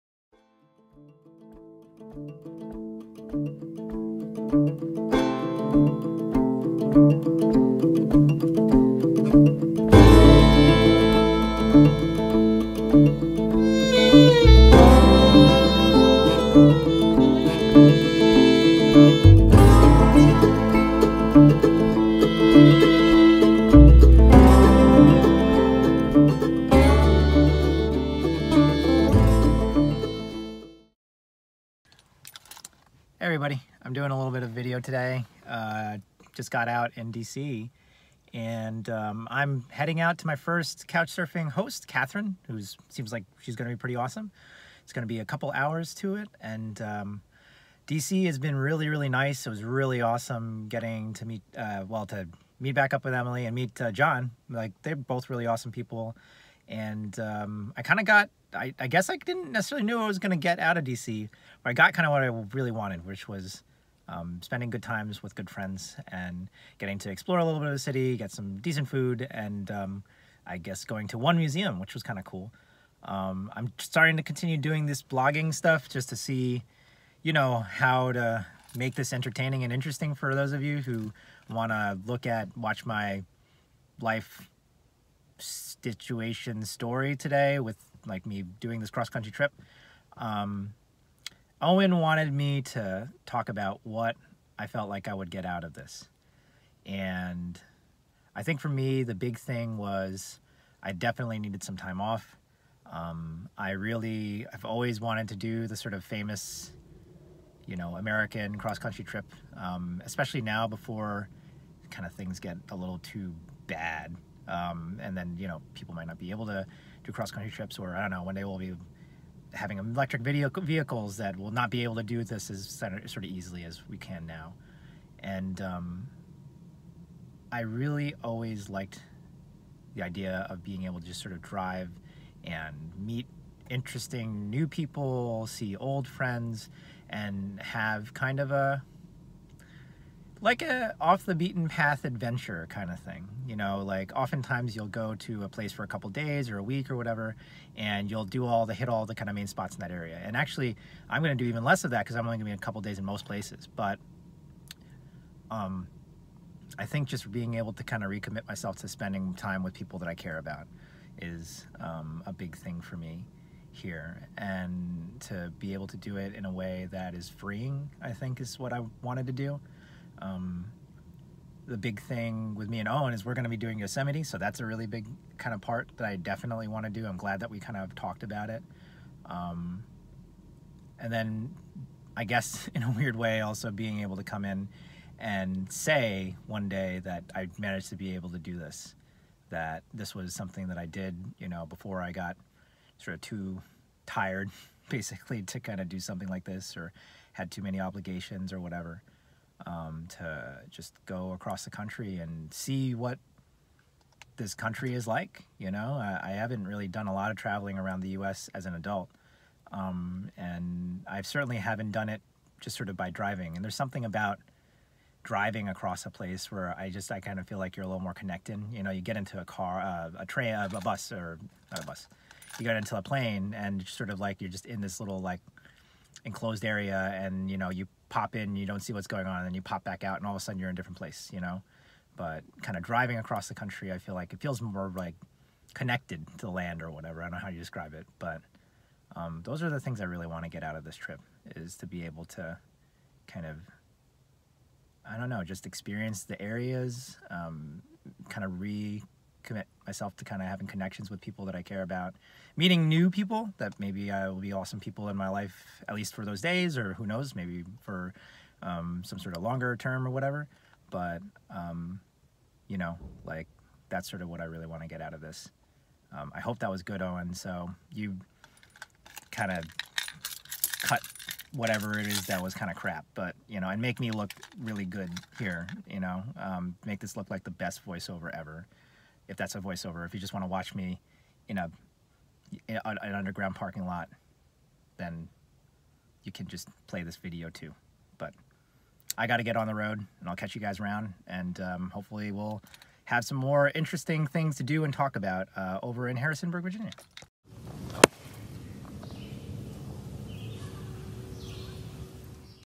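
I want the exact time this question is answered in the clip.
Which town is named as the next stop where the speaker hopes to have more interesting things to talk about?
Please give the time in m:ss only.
4:56.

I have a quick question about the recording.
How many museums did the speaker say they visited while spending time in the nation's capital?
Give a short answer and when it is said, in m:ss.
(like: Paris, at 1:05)
1, at 1:11.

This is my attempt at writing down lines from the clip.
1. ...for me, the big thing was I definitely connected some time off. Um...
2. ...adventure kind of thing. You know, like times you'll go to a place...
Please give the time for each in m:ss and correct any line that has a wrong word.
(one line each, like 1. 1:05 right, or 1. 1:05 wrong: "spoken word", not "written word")
1. 1:38 wrong: "needed", not "connected"
2. 2:22 wrong: "oftentimes", not "times".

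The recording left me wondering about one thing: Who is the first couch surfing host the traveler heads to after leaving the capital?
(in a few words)
Catherine.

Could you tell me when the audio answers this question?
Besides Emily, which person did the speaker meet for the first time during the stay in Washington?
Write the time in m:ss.
0:53.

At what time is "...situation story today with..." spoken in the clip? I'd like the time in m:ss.
1:25.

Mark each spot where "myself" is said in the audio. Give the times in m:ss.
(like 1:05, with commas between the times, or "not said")
2:38, 4:09.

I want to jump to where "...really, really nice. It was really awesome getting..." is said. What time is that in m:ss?
0:48.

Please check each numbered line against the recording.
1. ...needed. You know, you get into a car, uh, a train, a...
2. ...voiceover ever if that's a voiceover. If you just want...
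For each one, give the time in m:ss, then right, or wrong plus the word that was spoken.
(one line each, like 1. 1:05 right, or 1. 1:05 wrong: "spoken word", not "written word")
1. 3:38 wrong: "connected", not "needed"
2. 4:37 right.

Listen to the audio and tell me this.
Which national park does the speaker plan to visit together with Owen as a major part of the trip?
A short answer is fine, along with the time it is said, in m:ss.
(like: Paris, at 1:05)
Yosemite, at 2:53.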